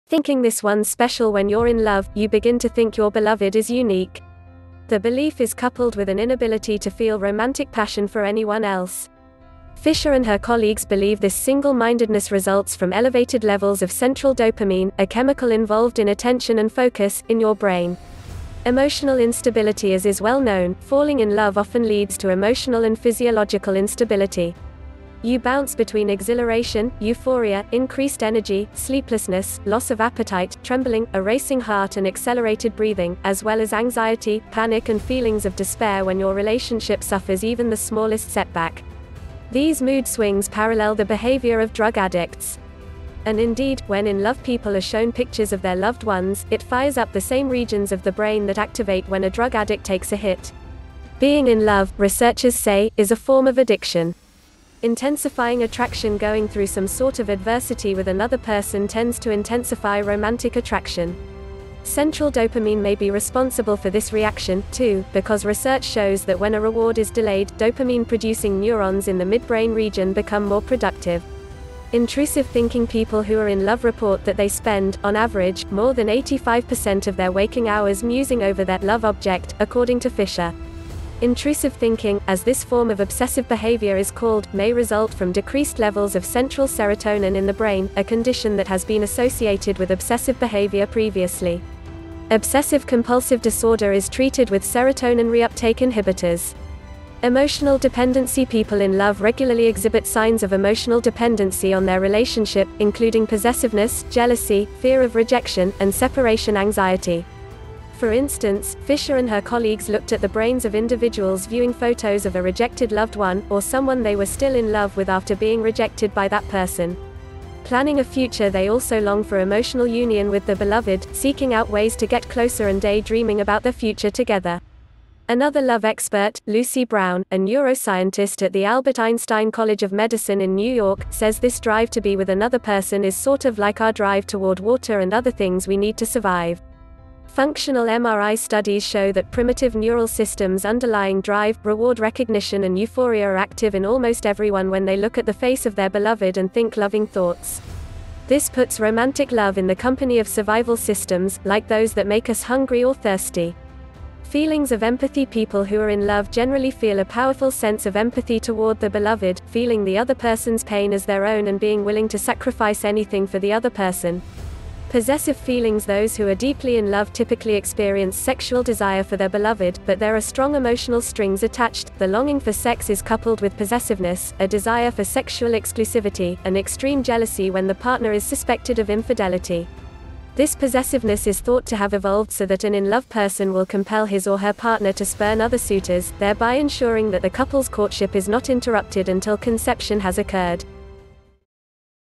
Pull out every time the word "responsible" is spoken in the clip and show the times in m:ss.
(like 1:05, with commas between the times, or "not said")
1:03.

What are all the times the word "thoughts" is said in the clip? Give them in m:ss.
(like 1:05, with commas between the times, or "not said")
2:27, 3:01.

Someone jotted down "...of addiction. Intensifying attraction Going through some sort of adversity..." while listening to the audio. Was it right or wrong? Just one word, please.
right.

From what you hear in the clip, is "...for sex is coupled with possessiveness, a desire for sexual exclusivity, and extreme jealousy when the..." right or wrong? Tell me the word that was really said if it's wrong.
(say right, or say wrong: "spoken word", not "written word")
right.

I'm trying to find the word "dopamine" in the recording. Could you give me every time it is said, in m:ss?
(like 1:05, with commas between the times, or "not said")
0:14, 1:02, 1:07.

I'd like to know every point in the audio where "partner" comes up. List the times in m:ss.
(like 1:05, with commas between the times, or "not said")
2:57, 3:04.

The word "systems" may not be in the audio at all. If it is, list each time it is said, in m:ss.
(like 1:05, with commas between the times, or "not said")
2:20, 2:30.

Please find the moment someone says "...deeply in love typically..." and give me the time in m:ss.
2:46.